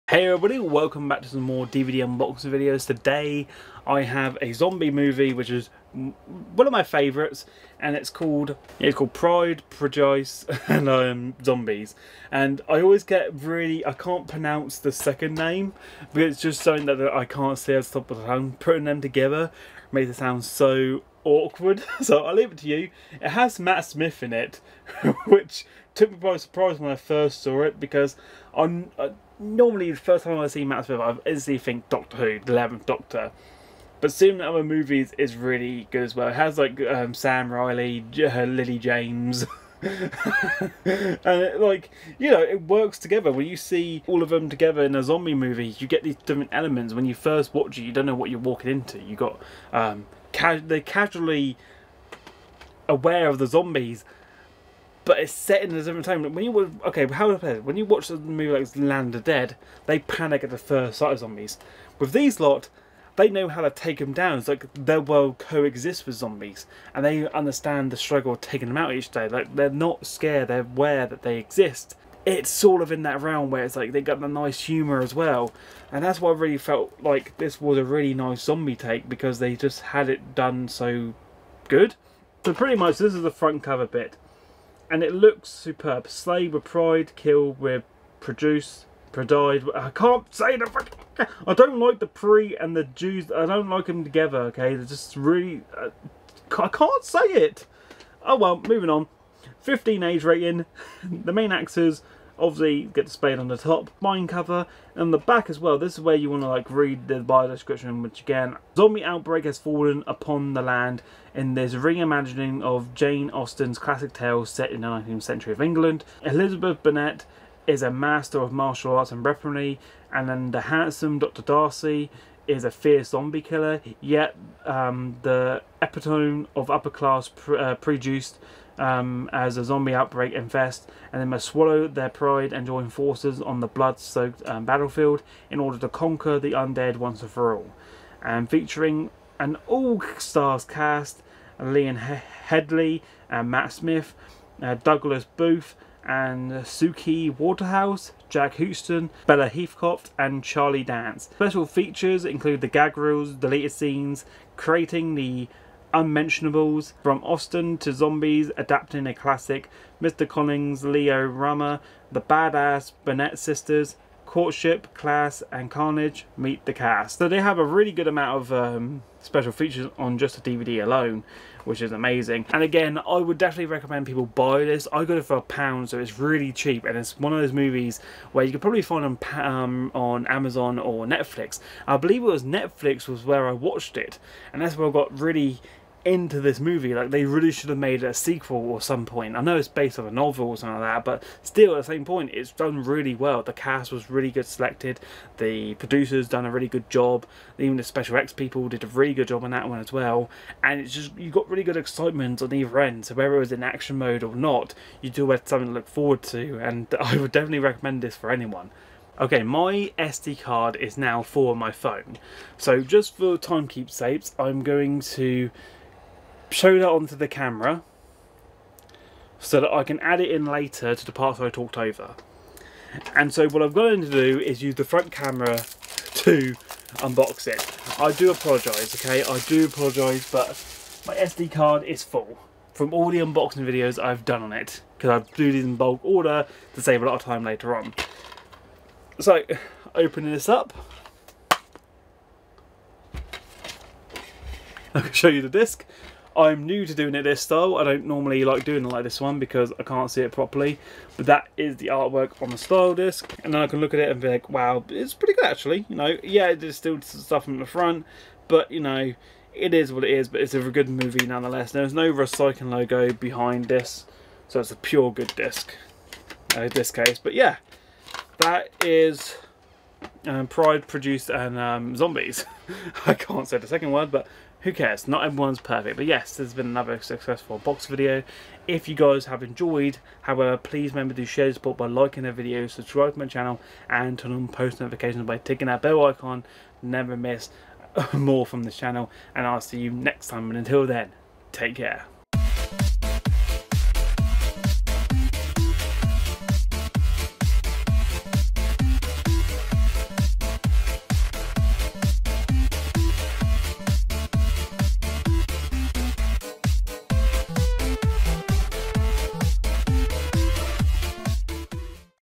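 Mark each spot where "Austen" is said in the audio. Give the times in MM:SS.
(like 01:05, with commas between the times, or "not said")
01:53, 02:37.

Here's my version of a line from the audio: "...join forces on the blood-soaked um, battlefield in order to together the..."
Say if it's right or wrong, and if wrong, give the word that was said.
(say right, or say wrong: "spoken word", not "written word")
wrong: "conquer", not "together".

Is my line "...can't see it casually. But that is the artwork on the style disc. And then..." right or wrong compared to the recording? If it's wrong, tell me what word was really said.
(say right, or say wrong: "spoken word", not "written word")
wrong: "properly", not "casually".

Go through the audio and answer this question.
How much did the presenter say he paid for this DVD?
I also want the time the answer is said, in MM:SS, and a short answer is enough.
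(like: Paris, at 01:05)
A pound, at 02:55.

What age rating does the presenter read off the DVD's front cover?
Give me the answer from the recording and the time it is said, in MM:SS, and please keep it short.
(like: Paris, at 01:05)
15, at 01:39.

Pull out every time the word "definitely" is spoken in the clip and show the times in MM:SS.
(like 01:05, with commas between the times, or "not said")
02:53, 03:27.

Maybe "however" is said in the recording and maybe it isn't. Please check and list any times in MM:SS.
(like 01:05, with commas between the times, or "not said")
04:40.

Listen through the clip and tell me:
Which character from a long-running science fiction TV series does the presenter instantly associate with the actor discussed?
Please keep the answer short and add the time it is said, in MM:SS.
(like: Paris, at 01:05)
The Eleventh Doctor, at 00:32.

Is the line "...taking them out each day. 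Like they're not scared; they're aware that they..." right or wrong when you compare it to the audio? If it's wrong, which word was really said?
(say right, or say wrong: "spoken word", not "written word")
right.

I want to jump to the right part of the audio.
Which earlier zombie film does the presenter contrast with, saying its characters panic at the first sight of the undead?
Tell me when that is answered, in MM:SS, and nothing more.
00:58.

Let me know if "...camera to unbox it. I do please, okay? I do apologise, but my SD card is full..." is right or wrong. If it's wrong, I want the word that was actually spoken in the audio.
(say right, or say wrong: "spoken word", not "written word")
wrong: "apologise", not "please".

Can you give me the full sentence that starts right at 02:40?
Collins, Leo Rama, the badass Burnett sisters, Courtship, Class, and Carnage meet the cast.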